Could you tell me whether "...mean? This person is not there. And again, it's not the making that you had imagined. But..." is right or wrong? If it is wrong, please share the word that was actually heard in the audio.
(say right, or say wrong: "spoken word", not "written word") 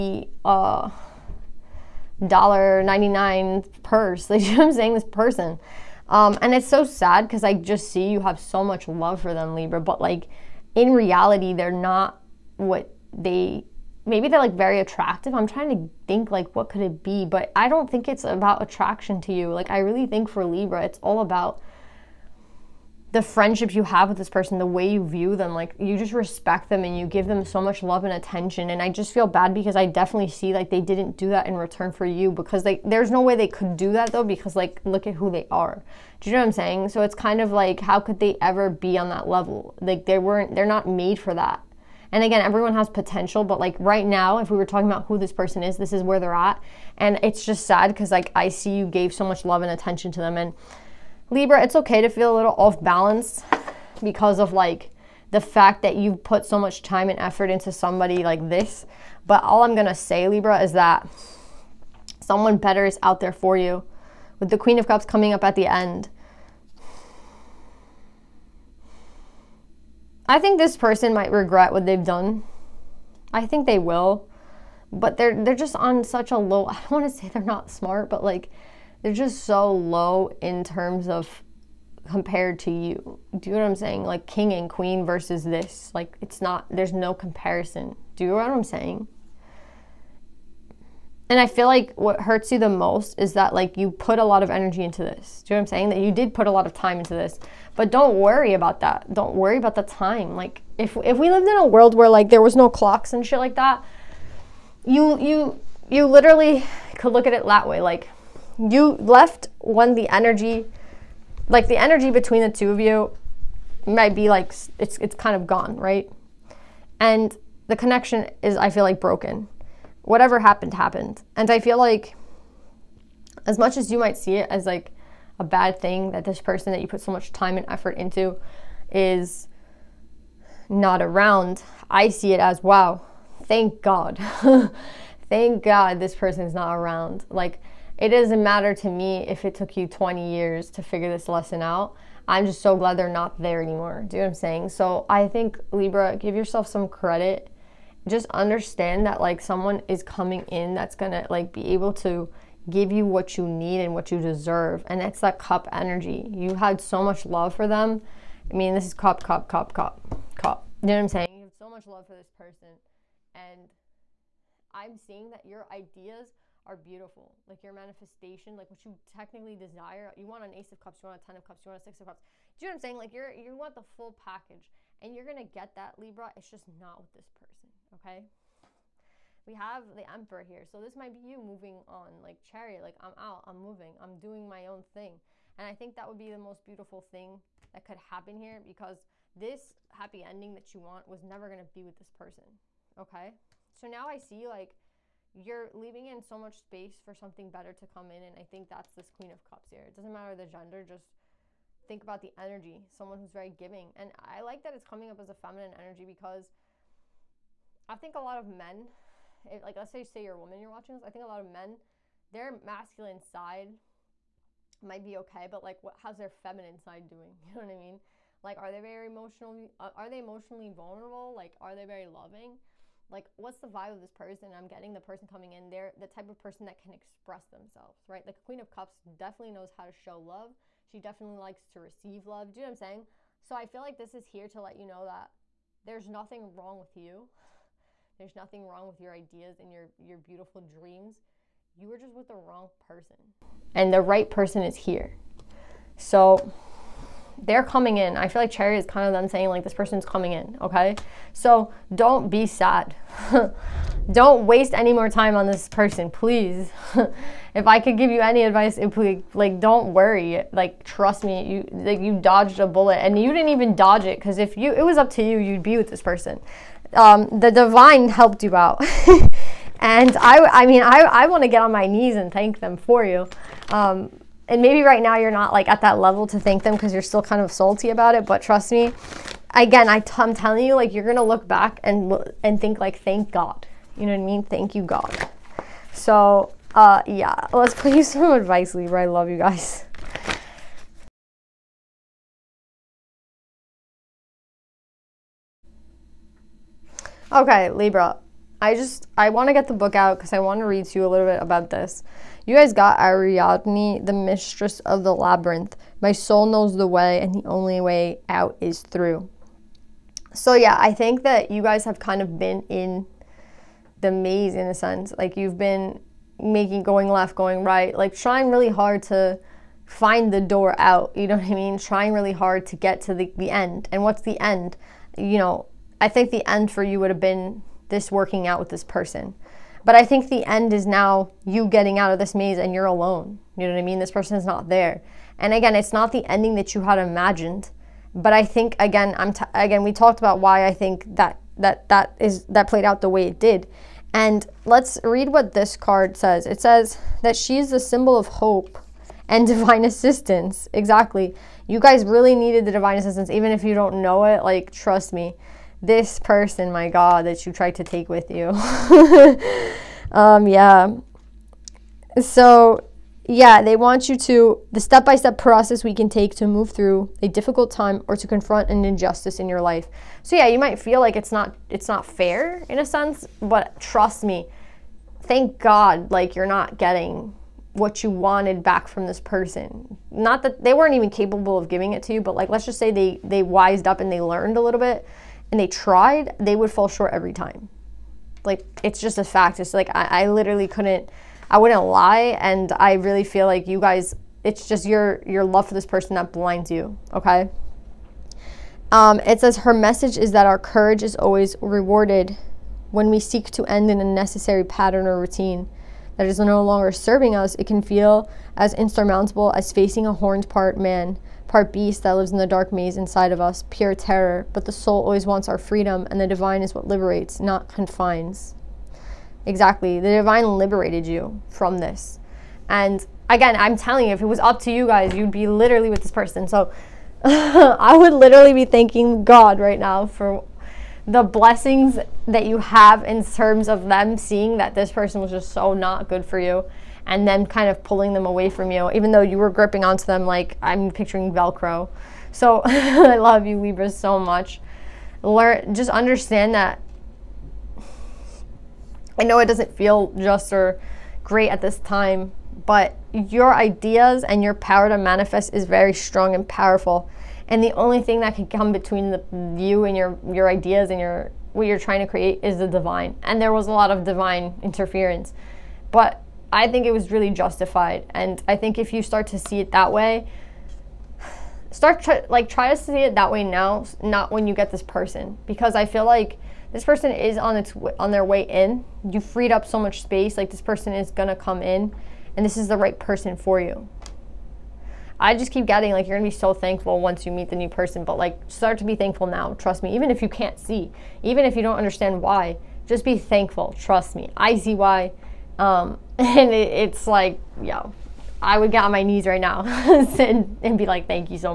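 wrong: "ending", not "making".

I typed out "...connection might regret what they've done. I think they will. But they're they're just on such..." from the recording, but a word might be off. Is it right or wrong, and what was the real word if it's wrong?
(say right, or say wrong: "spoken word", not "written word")
wrong: "person", not "connection".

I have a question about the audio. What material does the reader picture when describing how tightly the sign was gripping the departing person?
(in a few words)
Velcro.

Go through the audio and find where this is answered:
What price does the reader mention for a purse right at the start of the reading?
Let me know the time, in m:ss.
0:02.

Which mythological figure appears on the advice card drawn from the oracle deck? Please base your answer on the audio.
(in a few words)
Ariadne.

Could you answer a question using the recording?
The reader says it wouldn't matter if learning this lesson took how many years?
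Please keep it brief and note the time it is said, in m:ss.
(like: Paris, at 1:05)
20, at 2:19.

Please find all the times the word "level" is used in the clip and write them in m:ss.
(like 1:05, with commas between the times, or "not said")
0:39, 4:35.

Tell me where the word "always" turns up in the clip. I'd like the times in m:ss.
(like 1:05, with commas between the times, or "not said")
6:41, 6:55.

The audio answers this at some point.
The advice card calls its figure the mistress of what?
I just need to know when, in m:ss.
5:05.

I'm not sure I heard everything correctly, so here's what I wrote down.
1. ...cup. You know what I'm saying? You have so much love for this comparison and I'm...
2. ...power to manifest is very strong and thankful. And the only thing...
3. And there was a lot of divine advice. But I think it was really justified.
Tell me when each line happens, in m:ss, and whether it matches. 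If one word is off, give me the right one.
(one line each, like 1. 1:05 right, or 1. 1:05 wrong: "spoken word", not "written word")
1. 2:40 wrong: "person", not "comparison"
2. 7:34 wrong: "powerful", not "thankful"
3. 7:43 wrong: "interference", not "advice".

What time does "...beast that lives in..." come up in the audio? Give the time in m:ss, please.
6:51.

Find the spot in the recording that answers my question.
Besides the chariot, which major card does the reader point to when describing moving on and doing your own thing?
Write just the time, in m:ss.
3:00.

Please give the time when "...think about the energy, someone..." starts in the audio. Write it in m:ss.
3:21.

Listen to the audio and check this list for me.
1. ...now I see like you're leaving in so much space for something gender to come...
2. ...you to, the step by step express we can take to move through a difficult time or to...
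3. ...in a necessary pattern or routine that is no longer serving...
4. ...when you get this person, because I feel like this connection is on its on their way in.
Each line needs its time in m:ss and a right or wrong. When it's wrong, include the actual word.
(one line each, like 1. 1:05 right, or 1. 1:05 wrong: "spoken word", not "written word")
1. 3:13 wrong: "better", not "gender"
2. 6:04 wrong: "process", not "express"
3. 6:43 right
4. 7:54 wrong: "person", not "connection".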